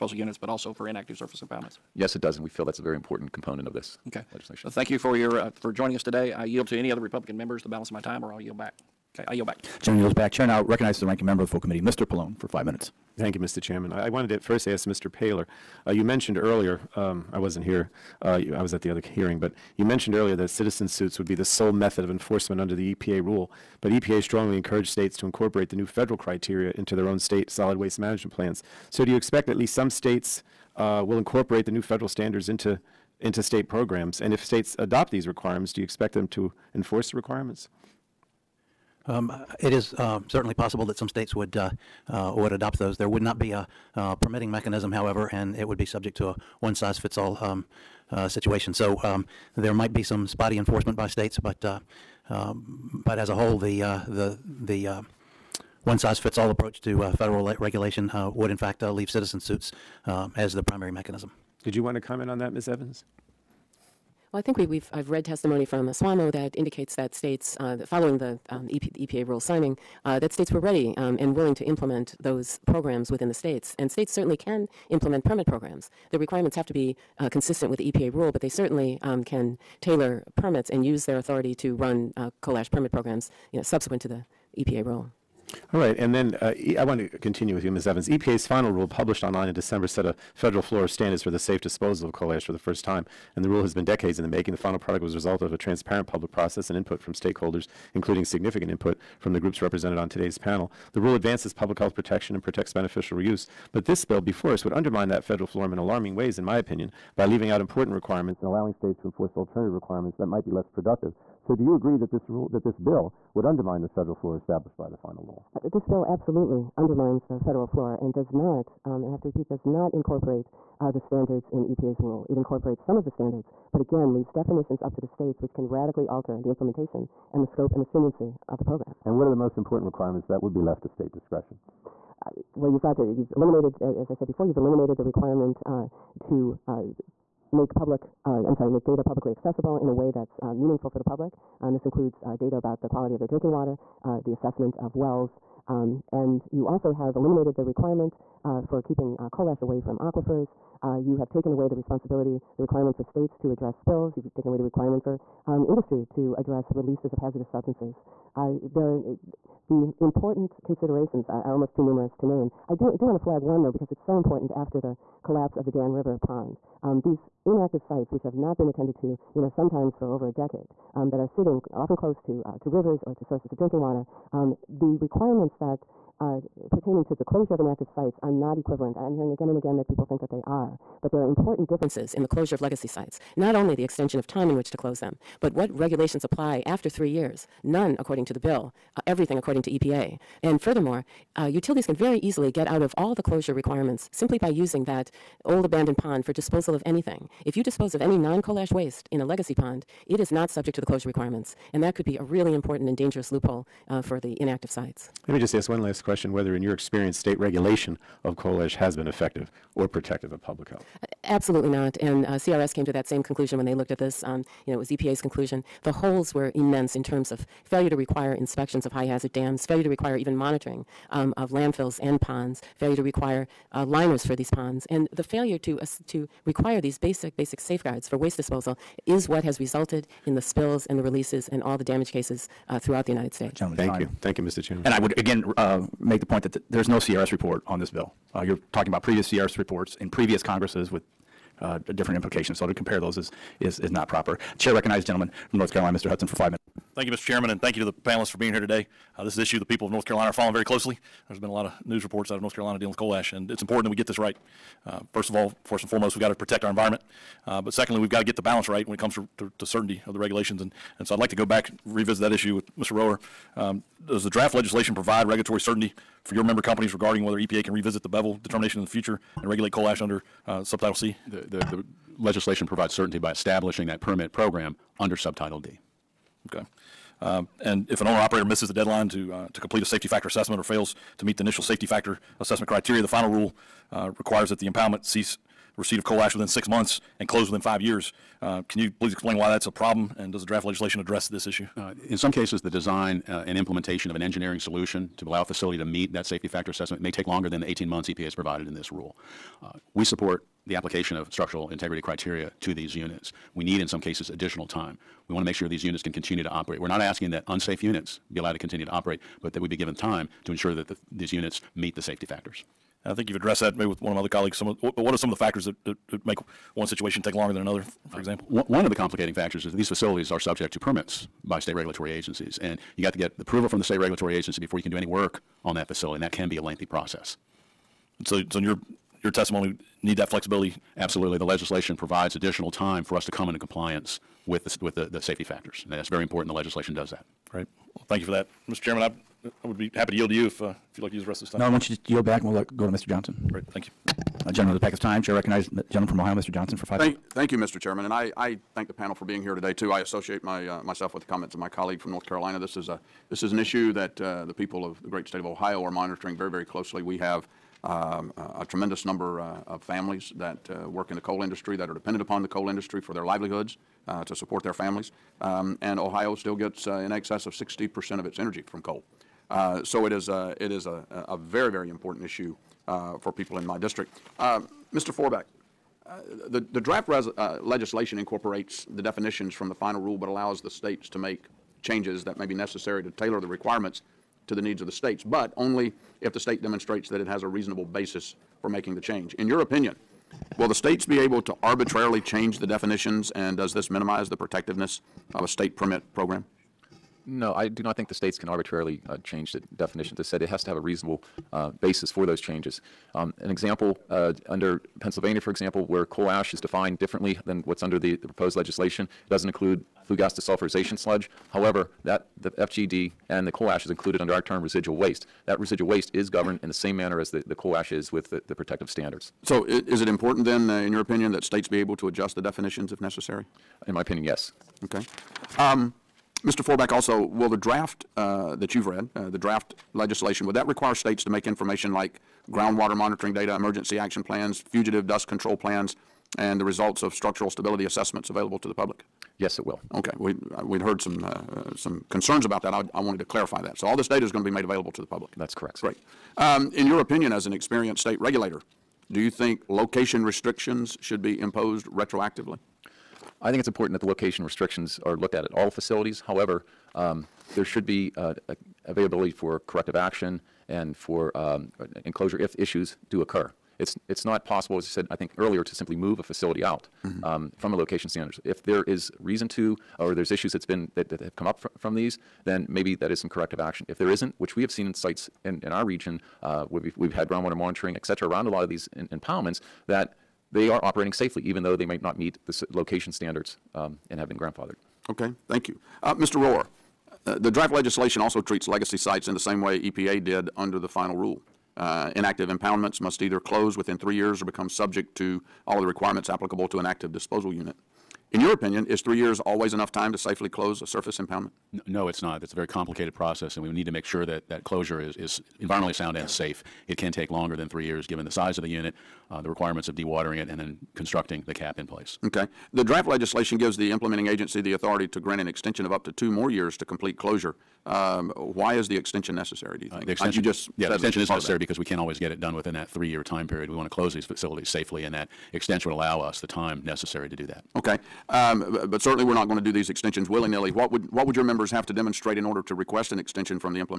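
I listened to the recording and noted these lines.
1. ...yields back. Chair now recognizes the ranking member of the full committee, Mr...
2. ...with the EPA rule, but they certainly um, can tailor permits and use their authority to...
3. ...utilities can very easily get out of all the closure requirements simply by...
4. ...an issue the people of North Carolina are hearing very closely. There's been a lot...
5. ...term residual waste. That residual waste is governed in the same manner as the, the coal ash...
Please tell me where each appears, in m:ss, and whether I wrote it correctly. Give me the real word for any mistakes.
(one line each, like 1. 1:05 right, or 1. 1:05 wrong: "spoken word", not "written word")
1. 0:09 right
2. 1:17 right
3. 3:11 right
4. 4:09 wrong: "following", not "hearing"
5. 6:54 right.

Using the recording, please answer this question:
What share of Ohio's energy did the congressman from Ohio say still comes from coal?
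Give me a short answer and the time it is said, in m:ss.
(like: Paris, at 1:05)
over 60 percent, at 6:07.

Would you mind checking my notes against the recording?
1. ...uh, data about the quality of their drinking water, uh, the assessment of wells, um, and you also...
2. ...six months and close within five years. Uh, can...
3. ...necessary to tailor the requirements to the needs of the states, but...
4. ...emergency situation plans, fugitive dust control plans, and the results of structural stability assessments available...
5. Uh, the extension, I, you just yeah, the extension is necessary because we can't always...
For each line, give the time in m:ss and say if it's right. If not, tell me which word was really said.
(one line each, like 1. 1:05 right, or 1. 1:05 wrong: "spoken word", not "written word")
1. 2:22 right
2. 4:46 right
3. 6:22 right
4. 7:13 wrong: "action", not "situation"
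5. 8:40 right.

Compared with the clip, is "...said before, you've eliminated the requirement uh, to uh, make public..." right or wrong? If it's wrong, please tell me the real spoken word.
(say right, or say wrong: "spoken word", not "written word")
right.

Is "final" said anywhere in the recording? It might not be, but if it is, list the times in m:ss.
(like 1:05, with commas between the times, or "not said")
1:28, 1:34, 1:54, 4:43, 6:19, 8:10.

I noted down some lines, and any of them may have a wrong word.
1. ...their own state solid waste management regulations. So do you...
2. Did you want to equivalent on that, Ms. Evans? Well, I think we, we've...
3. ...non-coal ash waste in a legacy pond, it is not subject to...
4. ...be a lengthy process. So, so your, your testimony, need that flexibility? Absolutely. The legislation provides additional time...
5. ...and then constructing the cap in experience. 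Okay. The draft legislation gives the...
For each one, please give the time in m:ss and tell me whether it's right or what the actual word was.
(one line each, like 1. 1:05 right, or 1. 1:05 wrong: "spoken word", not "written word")
1. 0:26 wrong: "plans", not "regulations"
2. 1:01 wrong: "comment", not "equivalent"
3. 3:18 right
4. 5:26 right
5. 8:30 wrong: "place", not "experience".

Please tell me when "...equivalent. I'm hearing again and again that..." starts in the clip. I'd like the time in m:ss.
2:58.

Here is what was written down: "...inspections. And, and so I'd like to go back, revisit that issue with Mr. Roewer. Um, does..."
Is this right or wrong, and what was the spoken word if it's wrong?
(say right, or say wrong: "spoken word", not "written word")
wrong: "regulations", not "inspections".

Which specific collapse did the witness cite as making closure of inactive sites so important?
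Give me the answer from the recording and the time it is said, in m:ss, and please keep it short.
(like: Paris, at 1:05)
Dan River pond, at 2:45.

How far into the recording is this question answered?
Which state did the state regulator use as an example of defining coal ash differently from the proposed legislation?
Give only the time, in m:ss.
6:45.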